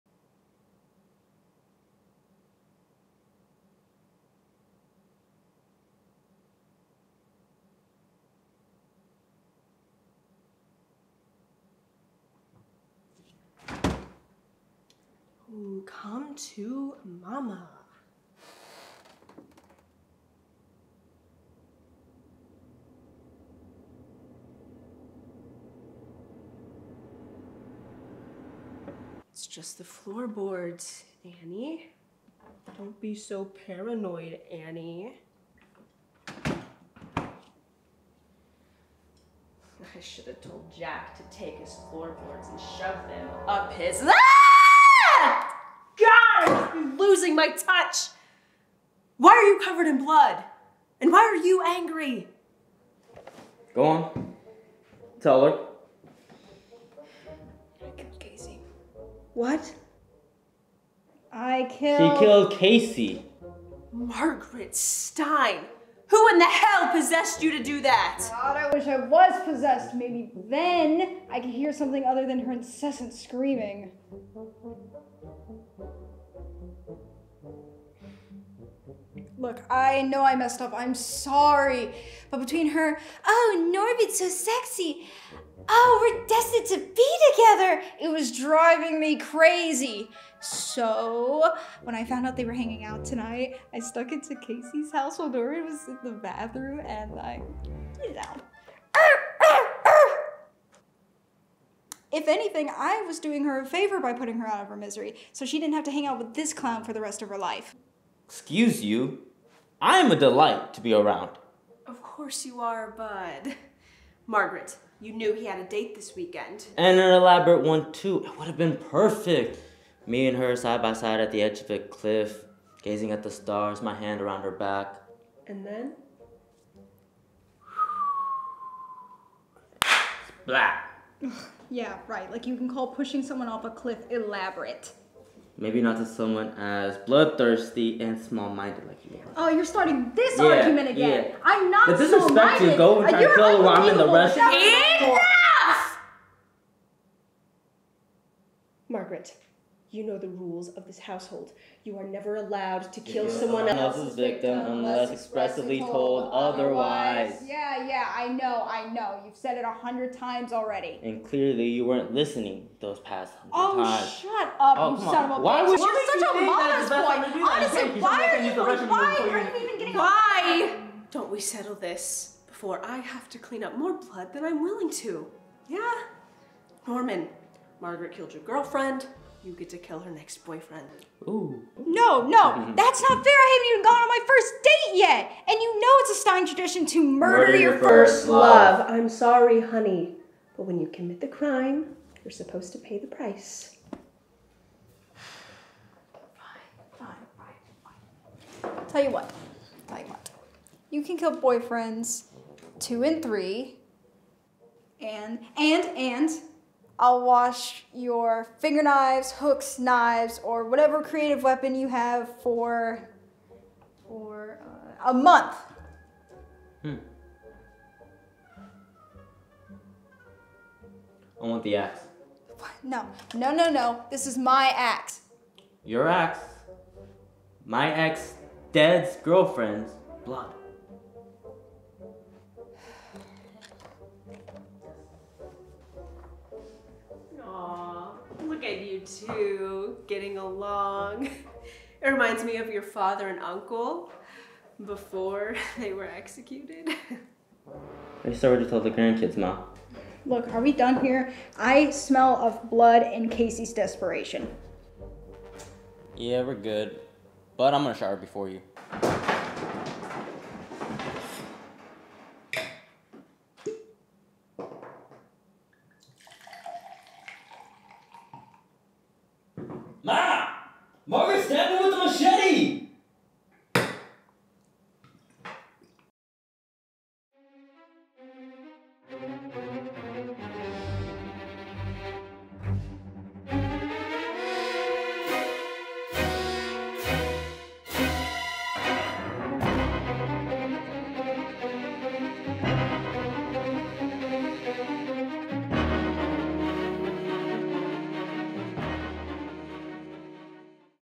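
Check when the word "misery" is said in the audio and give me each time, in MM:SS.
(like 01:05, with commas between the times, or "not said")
01:44.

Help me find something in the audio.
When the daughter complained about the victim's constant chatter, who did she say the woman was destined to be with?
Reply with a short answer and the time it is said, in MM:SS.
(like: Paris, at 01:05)
Norbit, at 01:24.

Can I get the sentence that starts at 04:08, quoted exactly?
I started to tell told the grandkids, Ma.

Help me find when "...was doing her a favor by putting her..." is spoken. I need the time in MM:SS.
01:43.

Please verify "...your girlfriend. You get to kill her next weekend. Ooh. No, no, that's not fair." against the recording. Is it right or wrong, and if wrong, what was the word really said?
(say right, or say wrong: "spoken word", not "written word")
wrong: "boyfriend", not "weekend".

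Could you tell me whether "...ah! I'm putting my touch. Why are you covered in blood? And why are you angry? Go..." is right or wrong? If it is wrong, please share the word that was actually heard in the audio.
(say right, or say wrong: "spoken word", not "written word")
wrong: "losing", not "putting".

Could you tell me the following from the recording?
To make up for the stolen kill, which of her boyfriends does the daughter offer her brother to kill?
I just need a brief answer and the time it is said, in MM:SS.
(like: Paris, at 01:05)
two and three, at 03:22.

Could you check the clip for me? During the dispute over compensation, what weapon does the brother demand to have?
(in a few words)
the axe.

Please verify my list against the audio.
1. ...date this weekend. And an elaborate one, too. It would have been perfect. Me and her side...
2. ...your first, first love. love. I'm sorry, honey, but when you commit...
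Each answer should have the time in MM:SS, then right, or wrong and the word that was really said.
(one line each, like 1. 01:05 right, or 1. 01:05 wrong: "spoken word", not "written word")
1. 01:55 right
2. 03:07 right.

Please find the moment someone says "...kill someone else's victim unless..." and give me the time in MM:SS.
02:33.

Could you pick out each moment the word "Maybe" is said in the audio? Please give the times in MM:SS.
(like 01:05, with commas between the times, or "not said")
01:09, 02:15.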